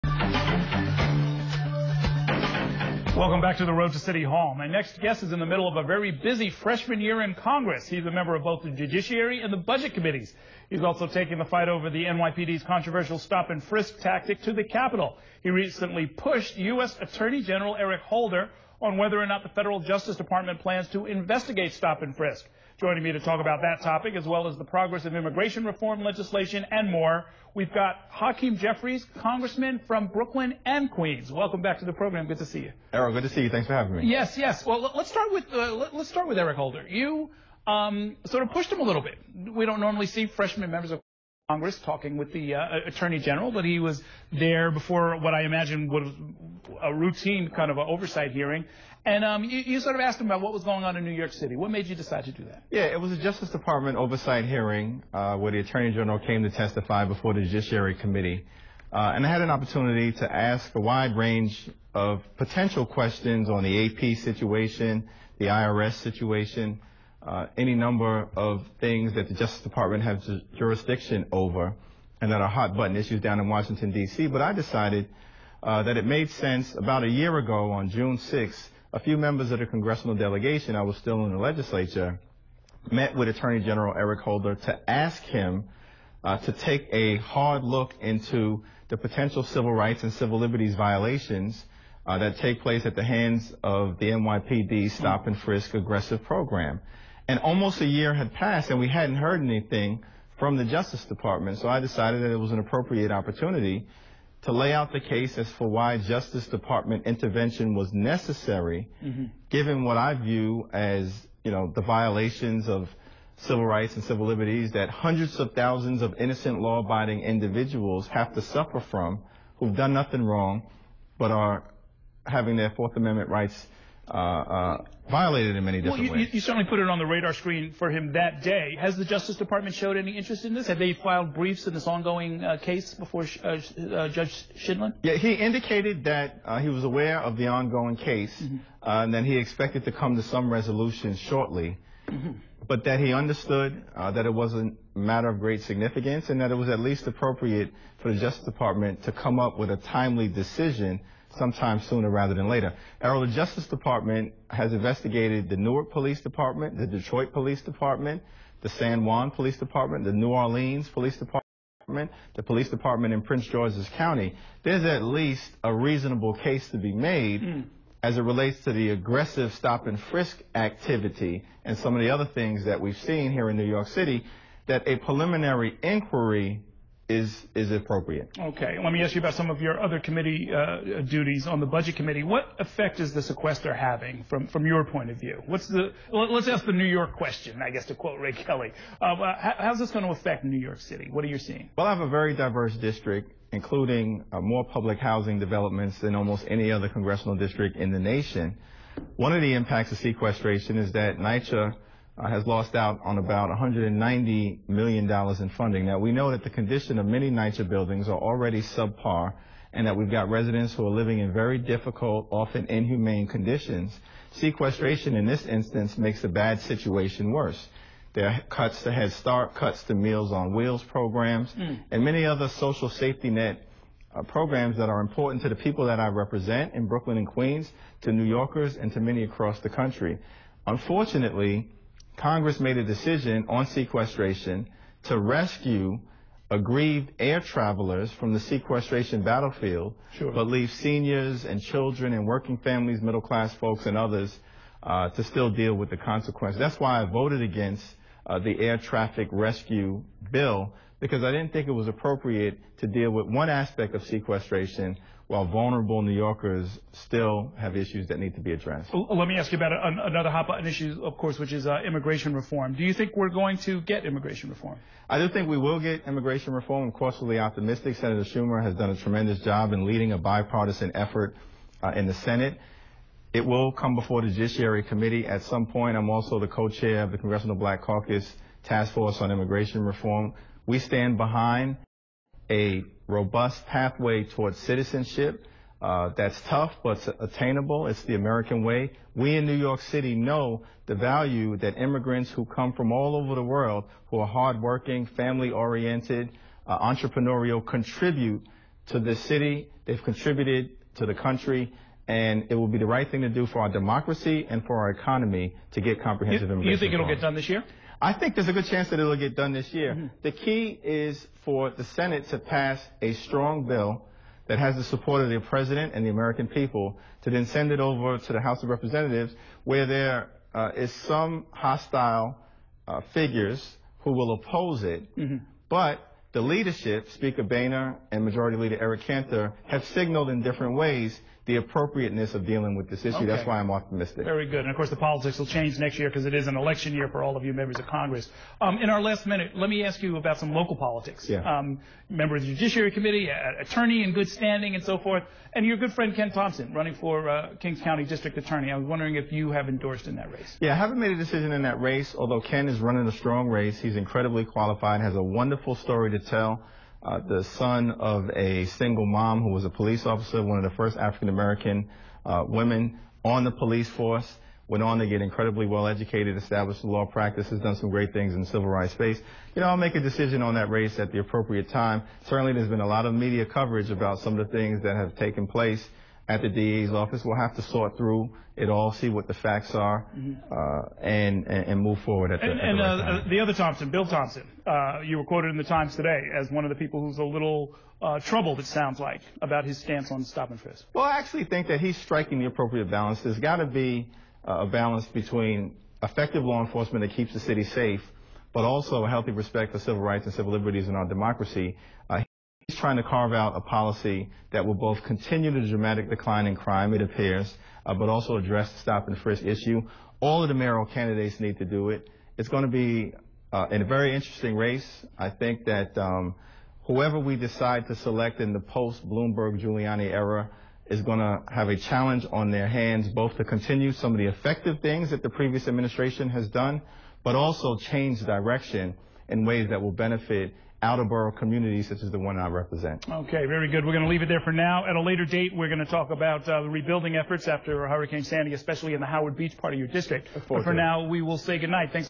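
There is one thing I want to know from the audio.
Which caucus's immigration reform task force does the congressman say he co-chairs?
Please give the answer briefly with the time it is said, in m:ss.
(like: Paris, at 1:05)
Congressional Black Caucus, at 4:37.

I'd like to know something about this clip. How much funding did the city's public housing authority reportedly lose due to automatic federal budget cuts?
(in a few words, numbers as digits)
$190 million.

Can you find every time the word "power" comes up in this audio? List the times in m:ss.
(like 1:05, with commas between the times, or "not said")
not said.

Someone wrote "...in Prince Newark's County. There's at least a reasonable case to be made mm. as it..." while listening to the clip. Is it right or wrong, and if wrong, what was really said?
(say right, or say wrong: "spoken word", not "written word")
wrong: "George", not "Newark".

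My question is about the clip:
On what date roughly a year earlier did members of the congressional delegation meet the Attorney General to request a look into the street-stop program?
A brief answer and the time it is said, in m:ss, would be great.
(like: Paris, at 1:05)
June 6th, at 1:17.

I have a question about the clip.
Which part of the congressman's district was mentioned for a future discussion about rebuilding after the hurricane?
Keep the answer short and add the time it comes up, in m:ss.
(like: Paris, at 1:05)
Howard Beach, at 7:19.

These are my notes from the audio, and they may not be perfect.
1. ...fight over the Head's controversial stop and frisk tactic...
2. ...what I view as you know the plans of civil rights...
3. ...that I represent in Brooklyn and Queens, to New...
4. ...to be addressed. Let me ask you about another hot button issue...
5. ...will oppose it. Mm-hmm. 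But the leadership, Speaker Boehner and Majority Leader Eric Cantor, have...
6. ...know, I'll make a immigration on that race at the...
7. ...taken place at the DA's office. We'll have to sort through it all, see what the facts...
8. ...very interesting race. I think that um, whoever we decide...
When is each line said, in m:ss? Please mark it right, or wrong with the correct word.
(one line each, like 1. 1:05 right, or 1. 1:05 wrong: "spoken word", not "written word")
1. 0:11 wrong: "NYPD", not "Head"
2. 1:49 wrong: "violations", not "plans"
3. 3:45 right
4. 4:18 right
5. 5:24 right
6. 6:09 wrong: "decision", not "immigration"
7. 6:15 right
8. 6:53 right.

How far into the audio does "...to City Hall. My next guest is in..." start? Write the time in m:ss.
0:03.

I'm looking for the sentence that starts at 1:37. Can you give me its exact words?
And almost a year had passed, and we hadn't heard anything from the Justice Department.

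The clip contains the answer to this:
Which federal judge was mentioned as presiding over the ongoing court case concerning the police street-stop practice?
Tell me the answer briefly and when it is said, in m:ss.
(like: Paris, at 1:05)
Judge Scheindlin, at 2:14.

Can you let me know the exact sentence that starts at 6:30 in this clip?
Well, I actually think that he's striking the appropriate balance.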